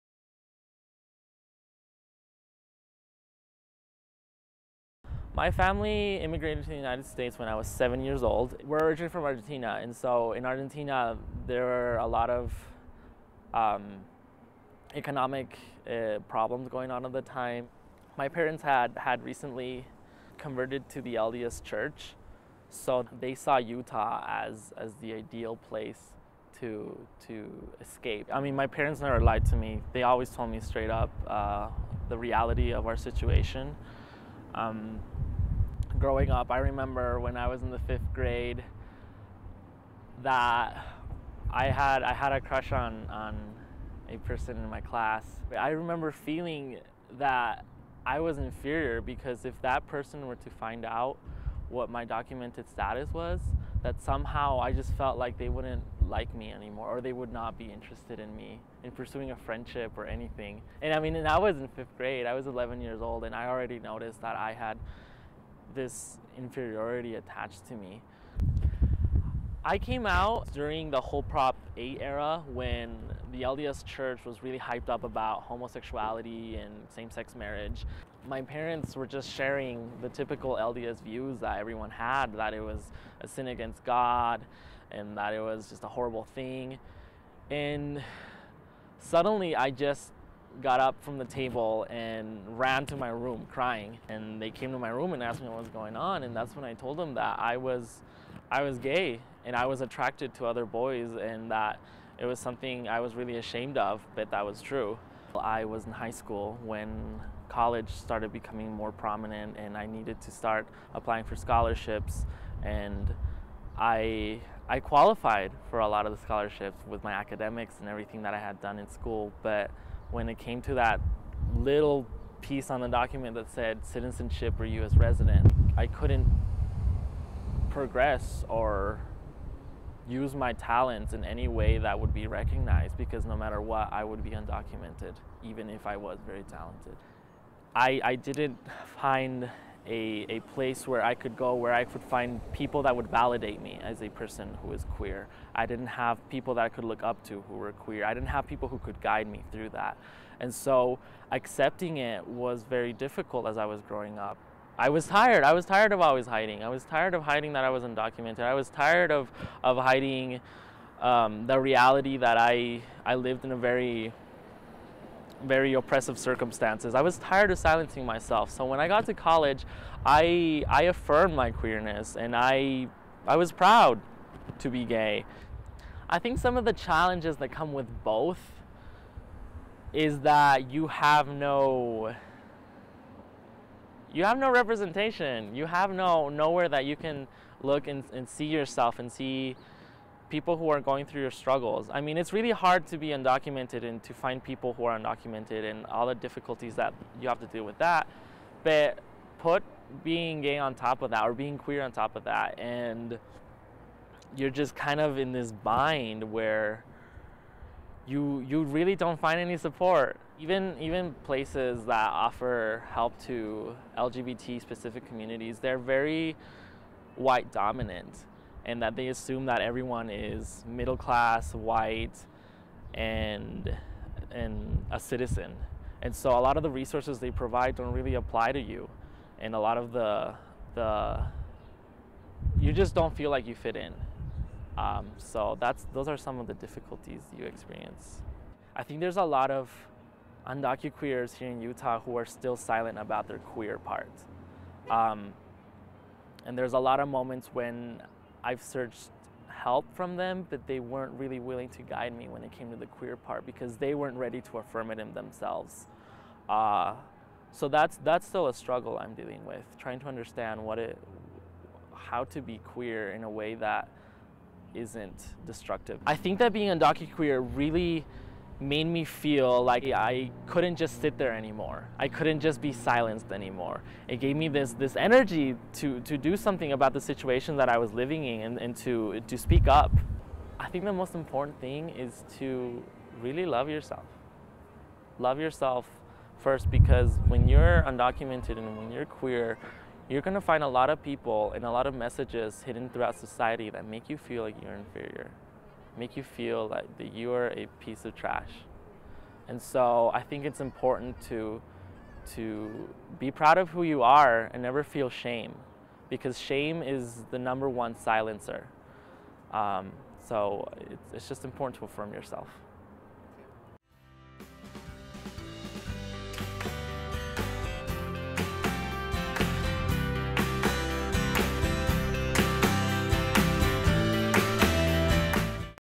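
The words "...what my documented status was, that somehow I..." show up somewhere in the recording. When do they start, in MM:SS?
00:51.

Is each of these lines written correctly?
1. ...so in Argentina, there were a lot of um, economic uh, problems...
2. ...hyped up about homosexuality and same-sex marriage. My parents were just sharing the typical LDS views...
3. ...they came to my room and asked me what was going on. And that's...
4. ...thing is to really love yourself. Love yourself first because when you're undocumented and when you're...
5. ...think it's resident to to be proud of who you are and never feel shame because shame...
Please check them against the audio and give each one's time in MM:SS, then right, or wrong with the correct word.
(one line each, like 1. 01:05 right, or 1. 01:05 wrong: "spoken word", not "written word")
1. 00:09 right
2. 01:14 right
3. 01:34 right
4. 04:41 right
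5. 05:00 wrong: "important", not "resident".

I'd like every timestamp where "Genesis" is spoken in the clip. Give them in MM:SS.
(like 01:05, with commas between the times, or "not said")
not said.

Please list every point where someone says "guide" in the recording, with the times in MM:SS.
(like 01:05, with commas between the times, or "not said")
02:29, 04:11.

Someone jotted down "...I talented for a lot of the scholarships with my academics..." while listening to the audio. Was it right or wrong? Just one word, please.
wrong.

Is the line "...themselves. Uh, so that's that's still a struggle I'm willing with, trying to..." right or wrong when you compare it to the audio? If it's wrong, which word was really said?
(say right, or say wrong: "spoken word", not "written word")
wrong: "dealing", not "willing".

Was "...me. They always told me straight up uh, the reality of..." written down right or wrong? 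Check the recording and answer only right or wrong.
right.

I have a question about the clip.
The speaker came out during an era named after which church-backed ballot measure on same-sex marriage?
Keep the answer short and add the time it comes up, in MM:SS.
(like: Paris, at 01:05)
Prop 8, at 01:11.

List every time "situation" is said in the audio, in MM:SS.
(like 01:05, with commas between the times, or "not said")
00:32, 04:37.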